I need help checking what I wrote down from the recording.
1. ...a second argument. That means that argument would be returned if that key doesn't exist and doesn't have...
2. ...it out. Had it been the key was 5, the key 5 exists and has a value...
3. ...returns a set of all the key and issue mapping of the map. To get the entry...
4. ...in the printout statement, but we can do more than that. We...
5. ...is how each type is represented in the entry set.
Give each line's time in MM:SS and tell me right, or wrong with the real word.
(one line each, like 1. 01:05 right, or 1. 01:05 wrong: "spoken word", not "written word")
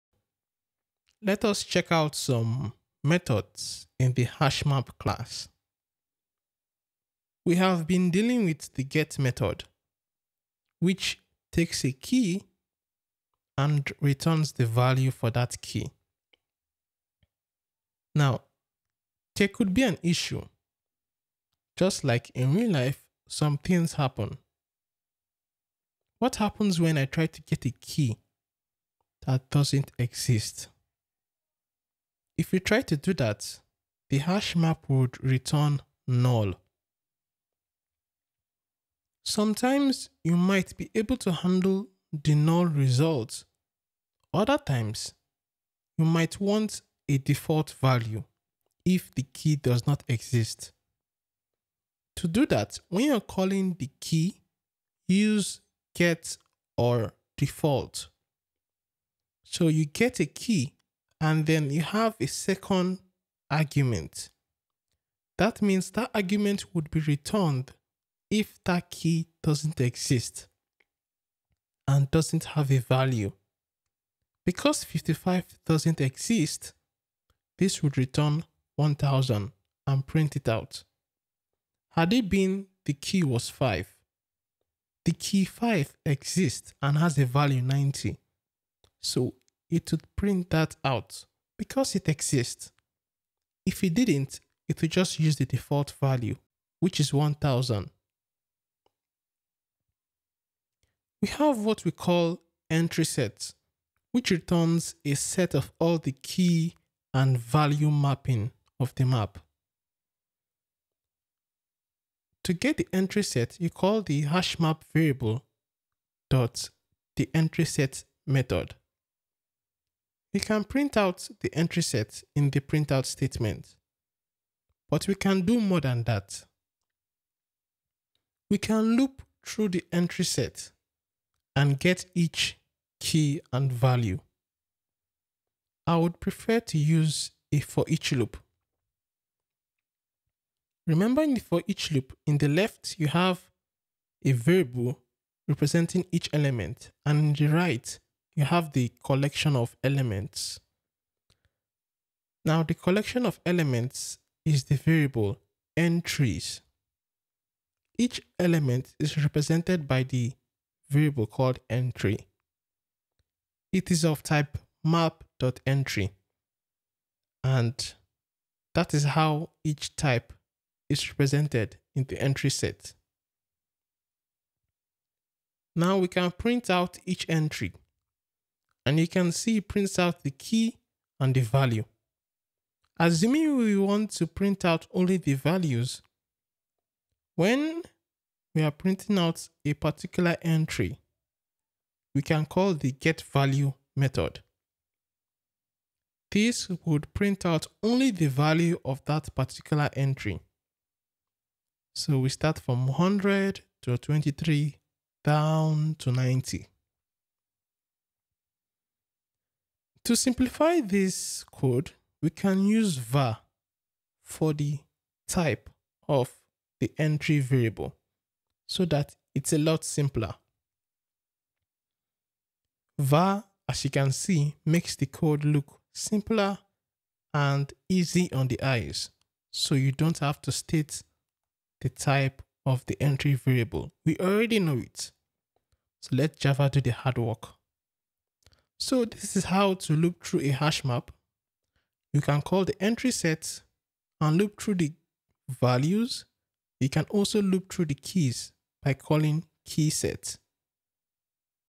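1. 01:02 right
2. 01:20 right
3. 01:44 wrong: "value", not "issue"
4. 02:02 right
5. 02:48 right.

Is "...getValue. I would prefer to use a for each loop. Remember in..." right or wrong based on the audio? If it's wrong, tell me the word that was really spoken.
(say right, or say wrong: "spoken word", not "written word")
wrong: "value", not "getValue".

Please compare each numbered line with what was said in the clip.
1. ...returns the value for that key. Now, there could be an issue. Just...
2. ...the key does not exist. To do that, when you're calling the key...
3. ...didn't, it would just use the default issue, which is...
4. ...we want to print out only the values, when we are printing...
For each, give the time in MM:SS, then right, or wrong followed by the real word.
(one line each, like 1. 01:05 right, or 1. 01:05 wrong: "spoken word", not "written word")
1. 00:14 right
2. 00:49 right
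3. 01:33 wrong: "value", not "issue"
4. 03:03 right.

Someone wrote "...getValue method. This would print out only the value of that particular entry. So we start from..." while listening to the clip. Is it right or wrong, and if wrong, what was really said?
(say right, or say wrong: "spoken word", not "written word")
right.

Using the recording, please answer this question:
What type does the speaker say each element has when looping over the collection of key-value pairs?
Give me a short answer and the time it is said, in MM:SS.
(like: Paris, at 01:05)
Map.Entry, at 02:44.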